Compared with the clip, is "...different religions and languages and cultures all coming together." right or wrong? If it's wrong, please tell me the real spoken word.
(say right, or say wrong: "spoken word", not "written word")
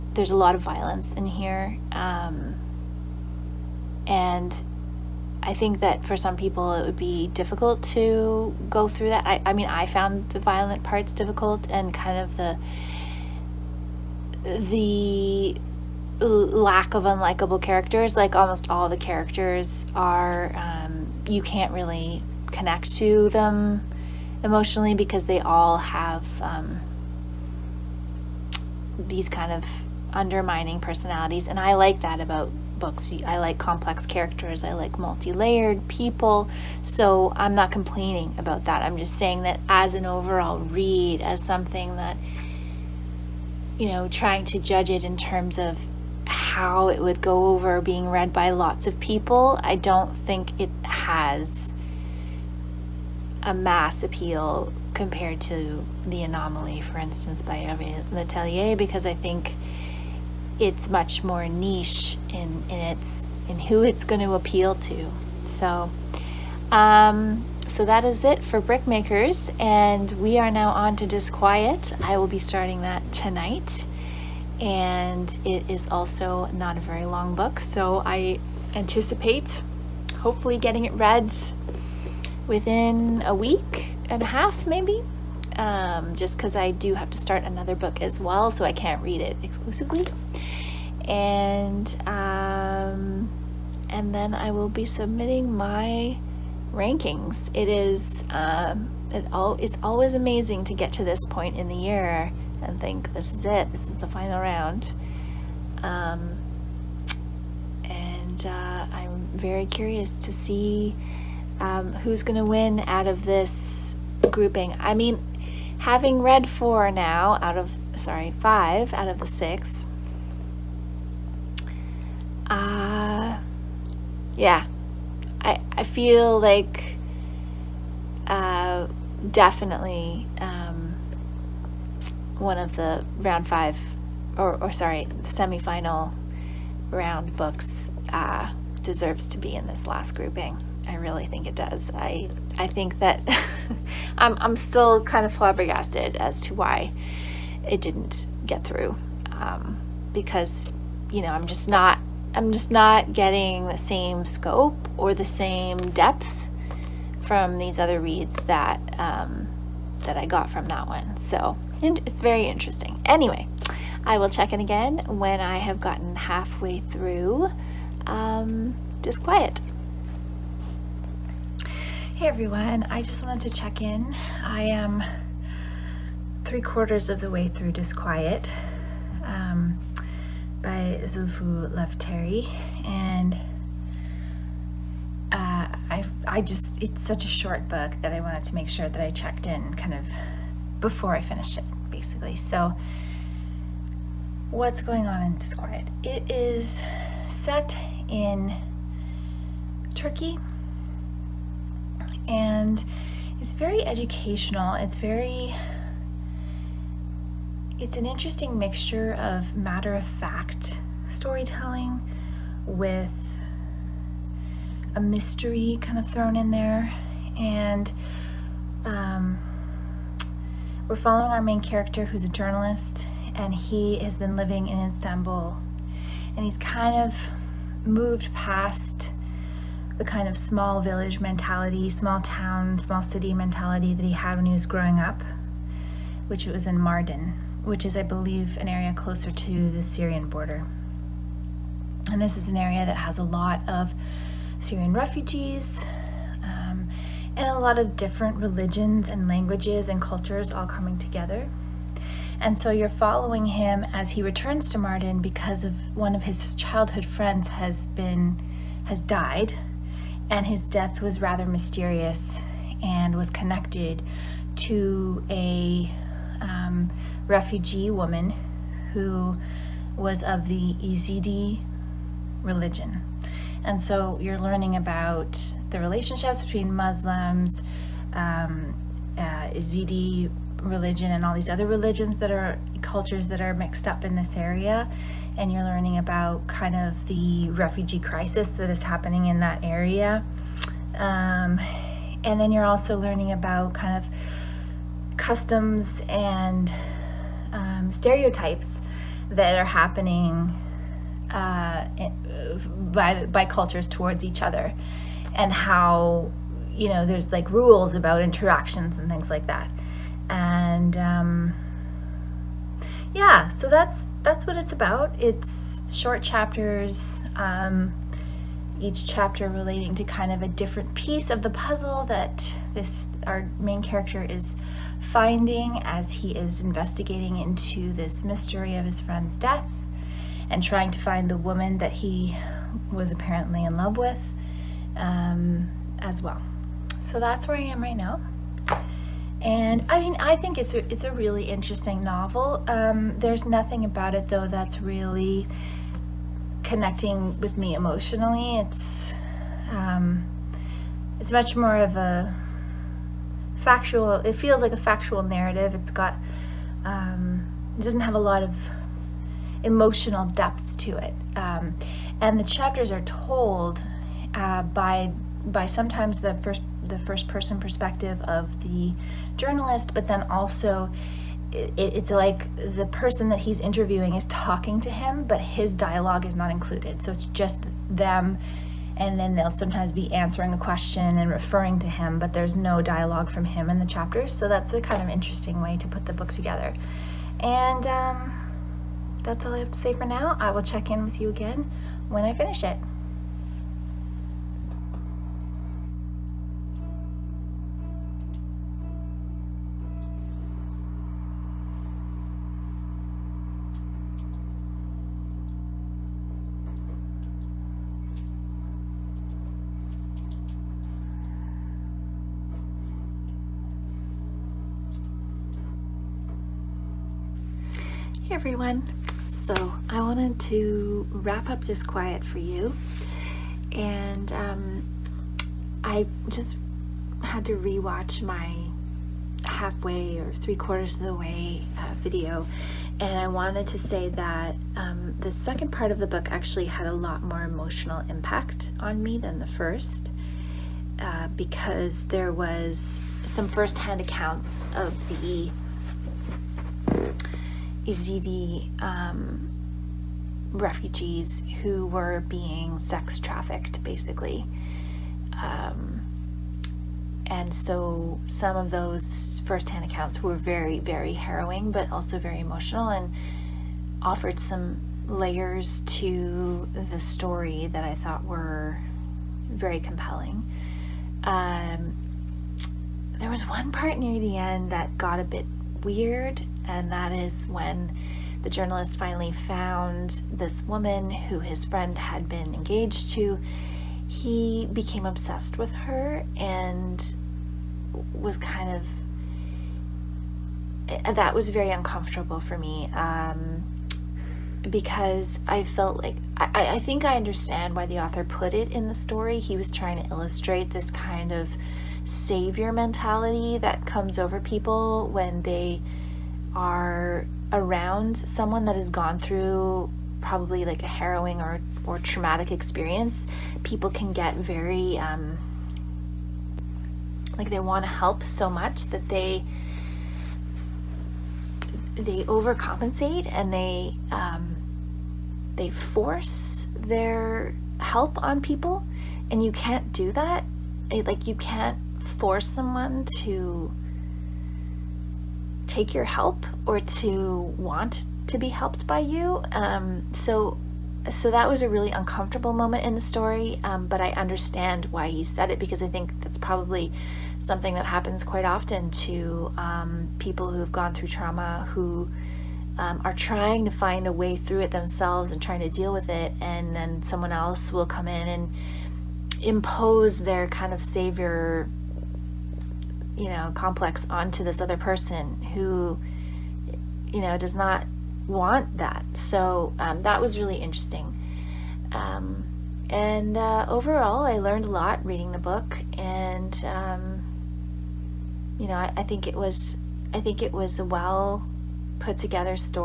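right.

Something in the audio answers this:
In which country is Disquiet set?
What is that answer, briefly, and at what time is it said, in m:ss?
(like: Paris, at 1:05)
Turkey, at 3:19.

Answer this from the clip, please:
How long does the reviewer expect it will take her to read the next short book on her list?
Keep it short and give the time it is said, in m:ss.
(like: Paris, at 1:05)
a week and a half, at 1:23.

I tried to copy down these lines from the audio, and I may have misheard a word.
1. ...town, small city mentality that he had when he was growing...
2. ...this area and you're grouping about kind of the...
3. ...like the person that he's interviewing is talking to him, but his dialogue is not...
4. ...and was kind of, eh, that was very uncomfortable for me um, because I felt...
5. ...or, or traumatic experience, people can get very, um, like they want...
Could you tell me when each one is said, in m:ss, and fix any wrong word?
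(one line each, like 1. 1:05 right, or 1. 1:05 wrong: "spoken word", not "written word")
1. 3:52 right
2. 4:44 wrong: "learning", not "grouping"
3. 6:12 right
4. 8:06 right
5. 8:31 right.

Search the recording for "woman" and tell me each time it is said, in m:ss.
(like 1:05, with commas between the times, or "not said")
4:27, 5:31, 8:00.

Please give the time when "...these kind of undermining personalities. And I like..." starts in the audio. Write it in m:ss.
0:28.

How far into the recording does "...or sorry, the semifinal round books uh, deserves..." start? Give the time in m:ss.
2:14.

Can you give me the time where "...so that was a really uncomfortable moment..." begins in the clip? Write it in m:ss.
9:01.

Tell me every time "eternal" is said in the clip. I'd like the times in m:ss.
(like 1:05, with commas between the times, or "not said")
not said.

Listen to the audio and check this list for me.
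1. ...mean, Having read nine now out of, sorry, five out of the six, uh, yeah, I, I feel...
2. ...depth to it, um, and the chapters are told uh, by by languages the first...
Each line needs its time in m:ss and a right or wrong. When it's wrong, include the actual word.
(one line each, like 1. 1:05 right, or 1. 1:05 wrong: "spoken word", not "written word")
1. 1:54 wrong: "four", not "nine"
2. 6:00 wrong: "sometimes", not "languages".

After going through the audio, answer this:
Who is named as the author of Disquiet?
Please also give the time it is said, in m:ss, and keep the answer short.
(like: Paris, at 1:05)
Zulfu Terry, at 3:01.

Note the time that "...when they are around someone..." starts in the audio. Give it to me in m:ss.
8:25.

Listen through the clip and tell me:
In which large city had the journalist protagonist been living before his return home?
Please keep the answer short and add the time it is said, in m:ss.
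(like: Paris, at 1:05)
Istanbul, at 3:44.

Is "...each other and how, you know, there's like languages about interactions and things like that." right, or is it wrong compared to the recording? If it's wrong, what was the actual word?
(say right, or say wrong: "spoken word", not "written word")
wrong: "rules", not "languages".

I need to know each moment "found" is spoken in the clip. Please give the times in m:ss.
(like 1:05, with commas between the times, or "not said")
0:09, 7:59.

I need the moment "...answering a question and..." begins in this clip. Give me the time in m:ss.
6:20.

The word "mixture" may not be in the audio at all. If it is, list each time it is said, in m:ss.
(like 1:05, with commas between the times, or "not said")
3:28.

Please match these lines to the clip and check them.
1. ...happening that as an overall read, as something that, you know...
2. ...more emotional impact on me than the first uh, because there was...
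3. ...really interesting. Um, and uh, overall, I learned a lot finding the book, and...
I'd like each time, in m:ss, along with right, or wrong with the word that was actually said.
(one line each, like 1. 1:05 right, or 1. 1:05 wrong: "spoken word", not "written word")
1. 0:39 wrong: "saying", not "happening"
2. 7:17 right
3. 9:30 wrong: "reading", not "finding".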